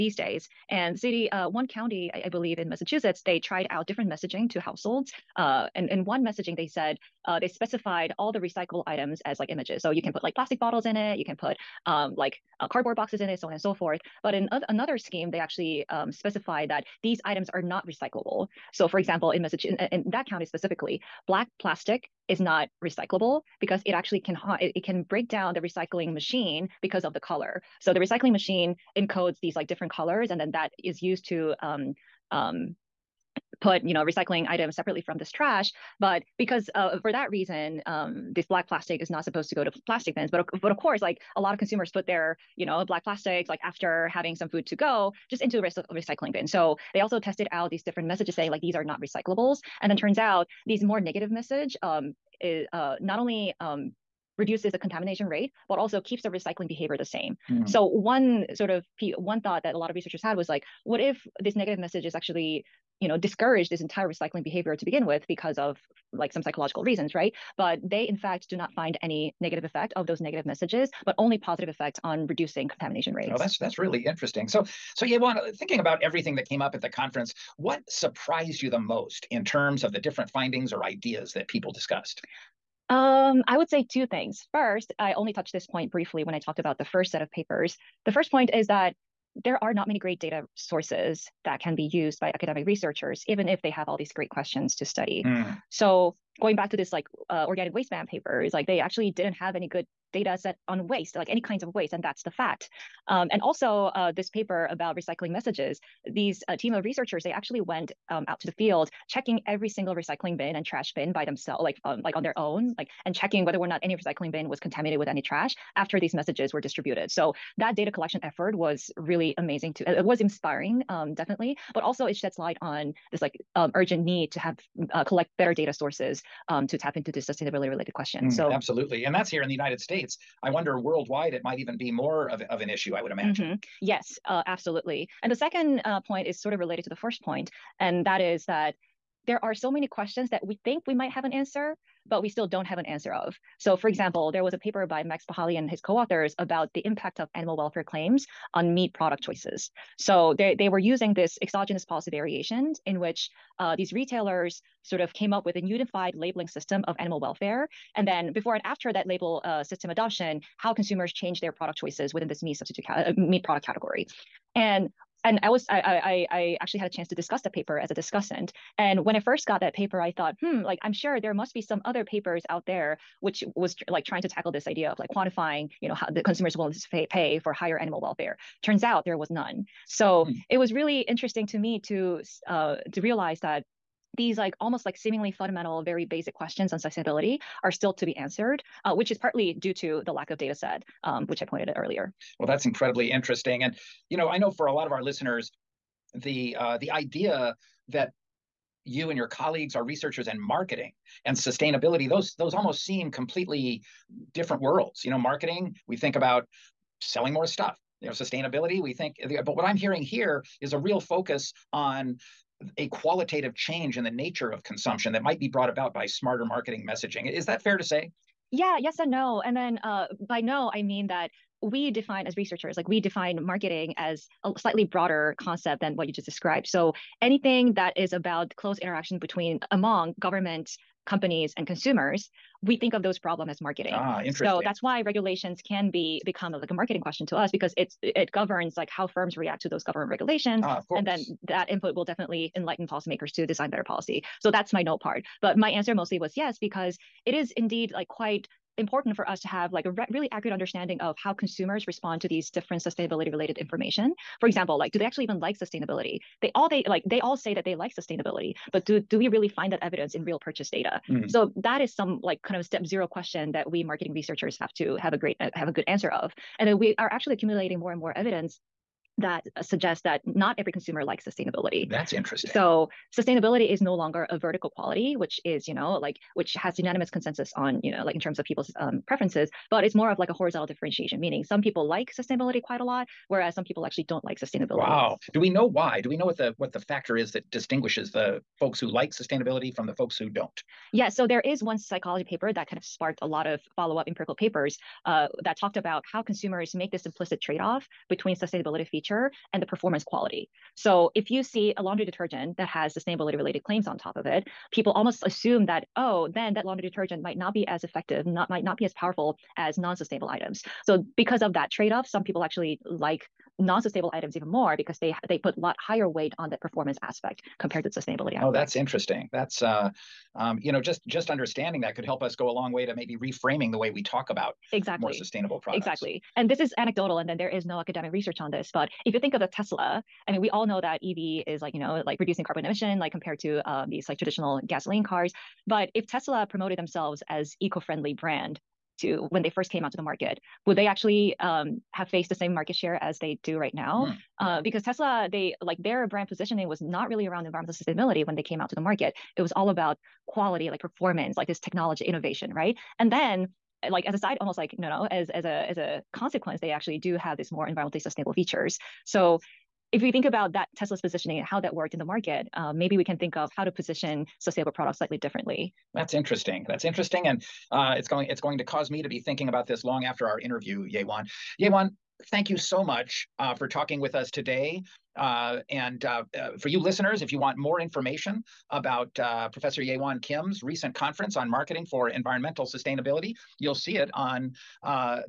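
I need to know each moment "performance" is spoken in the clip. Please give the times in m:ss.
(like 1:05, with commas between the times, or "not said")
4:59, 5:16, 5:50.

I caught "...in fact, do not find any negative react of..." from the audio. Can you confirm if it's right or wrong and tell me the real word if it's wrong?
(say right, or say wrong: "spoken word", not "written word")
wrong: "effect", not "react".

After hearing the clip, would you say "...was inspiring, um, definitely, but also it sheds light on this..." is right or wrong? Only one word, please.
right.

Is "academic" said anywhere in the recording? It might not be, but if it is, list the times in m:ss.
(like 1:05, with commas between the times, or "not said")
1:32, 5:27.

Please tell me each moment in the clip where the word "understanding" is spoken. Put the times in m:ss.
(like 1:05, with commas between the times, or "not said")
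4:10, 5:21.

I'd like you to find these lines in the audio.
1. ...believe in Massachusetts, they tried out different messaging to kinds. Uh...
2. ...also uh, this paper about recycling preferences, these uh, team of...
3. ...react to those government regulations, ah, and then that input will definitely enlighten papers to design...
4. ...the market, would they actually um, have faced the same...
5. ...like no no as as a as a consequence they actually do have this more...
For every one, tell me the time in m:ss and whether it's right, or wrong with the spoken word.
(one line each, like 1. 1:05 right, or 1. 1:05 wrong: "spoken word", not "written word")
1. 0:02 wrong: "households", not "kinds"
2. 1:43 wrong: "messages", not "preferences"
3. 3:59 wrong: "policymakers", not "papers"
4. 5:39 right
5. 5:54 right.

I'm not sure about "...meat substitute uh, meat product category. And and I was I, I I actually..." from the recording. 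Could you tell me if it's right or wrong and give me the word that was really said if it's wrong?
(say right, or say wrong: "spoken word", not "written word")
right.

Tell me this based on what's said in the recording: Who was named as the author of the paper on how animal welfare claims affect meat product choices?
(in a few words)
Max Pachali.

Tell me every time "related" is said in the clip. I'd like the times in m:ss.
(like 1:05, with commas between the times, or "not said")
2:07, 2:16, 4:13, 5:03.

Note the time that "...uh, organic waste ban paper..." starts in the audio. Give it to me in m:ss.
1:37.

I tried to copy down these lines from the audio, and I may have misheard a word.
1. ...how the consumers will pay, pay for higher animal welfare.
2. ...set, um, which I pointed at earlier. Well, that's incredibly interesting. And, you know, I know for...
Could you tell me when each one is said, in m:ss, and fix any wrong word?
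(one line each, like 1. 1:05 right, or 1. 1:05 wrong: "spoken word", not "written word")
1. 2:55 right
2. 3:10 right.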